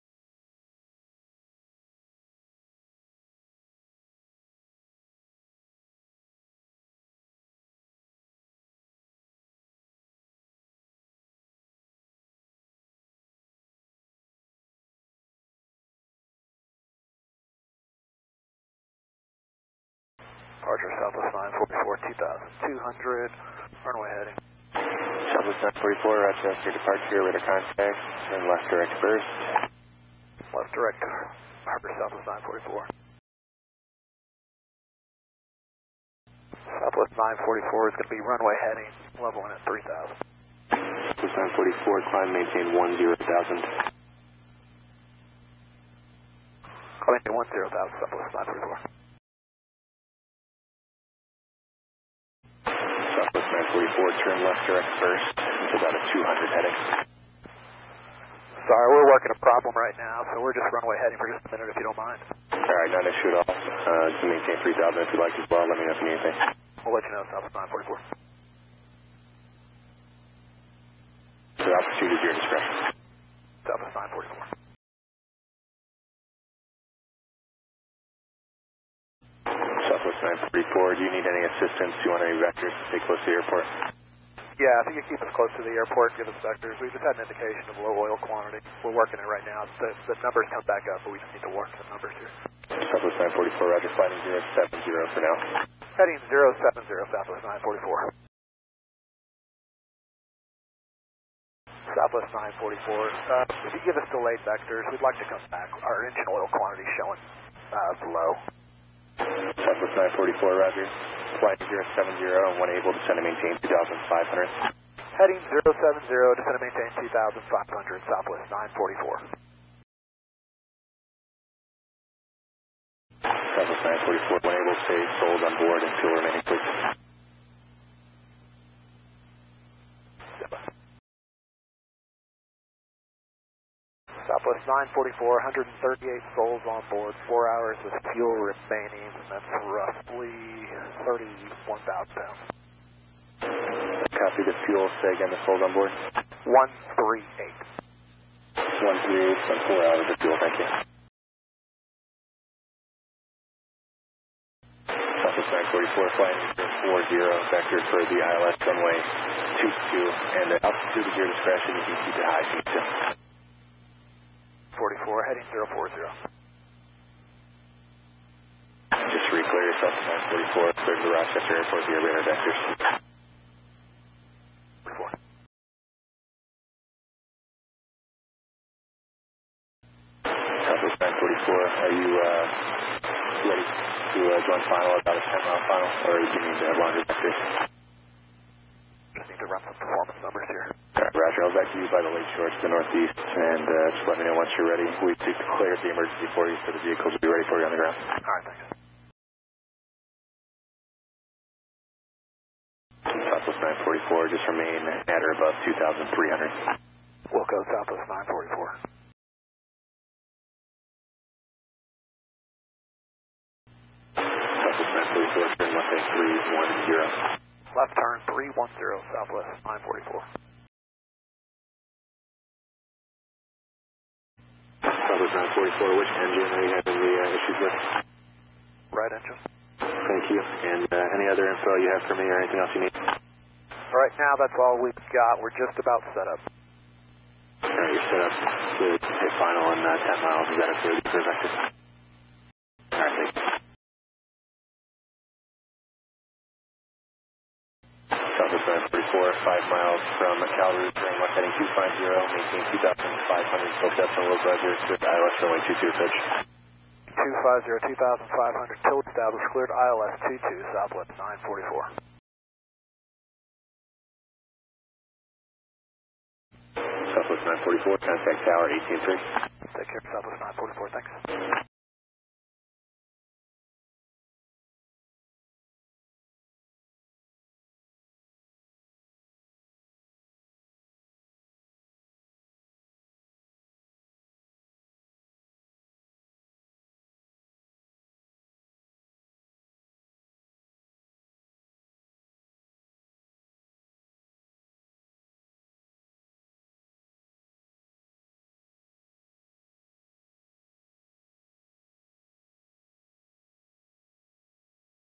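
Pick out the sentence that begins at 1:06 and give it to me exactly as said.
We'll let you know, Southwest 944.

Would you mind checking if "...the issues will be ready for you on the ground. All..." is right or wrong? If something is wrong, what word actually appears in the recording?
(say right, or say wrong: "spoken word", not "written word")
wrong: "vehicles", not "issues".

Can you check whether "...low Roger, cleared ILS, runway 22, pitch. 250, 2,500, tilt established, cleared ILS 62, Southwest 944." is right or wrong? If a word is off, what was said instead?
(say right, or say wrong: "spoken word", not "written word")
wrong: "22", not "62".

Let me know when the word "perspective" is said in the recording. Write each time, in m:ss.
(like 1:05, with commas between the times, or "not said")
4:01.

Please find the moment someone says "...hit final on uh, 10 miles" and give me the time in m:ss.
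3:59.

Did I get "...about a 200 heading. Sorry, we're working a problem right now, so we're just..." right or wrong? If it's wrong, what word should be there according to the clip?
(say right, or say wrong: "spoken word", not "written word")
right.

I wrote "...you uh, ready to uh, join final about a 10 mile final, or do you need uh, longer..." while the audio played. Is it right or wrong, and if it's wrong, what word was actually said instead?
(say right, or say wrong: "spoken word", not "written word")
right.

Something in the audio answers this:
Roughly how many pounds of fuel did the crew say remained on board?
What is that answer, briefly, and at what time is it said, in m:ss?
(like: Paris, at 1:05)
31,000 pounds, at 2:21.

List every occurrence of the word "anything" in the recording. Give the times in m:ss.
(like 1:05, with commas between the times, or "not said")
1:06, 3:52.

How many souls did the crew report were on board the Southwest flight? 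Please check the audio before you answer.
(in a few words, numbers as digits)
138.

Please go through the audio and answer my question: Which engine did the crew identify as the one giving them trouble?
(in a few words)
Right engine.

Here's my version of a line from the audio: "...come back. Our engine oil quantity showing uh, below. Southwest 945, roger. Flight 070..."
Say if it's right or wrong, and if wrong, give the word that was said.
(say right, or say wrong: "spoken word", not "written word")
wrong: "944", not "945".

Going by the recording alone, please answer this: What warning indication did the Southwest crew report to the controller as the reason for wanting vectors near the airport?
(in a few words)
Low oil quantity.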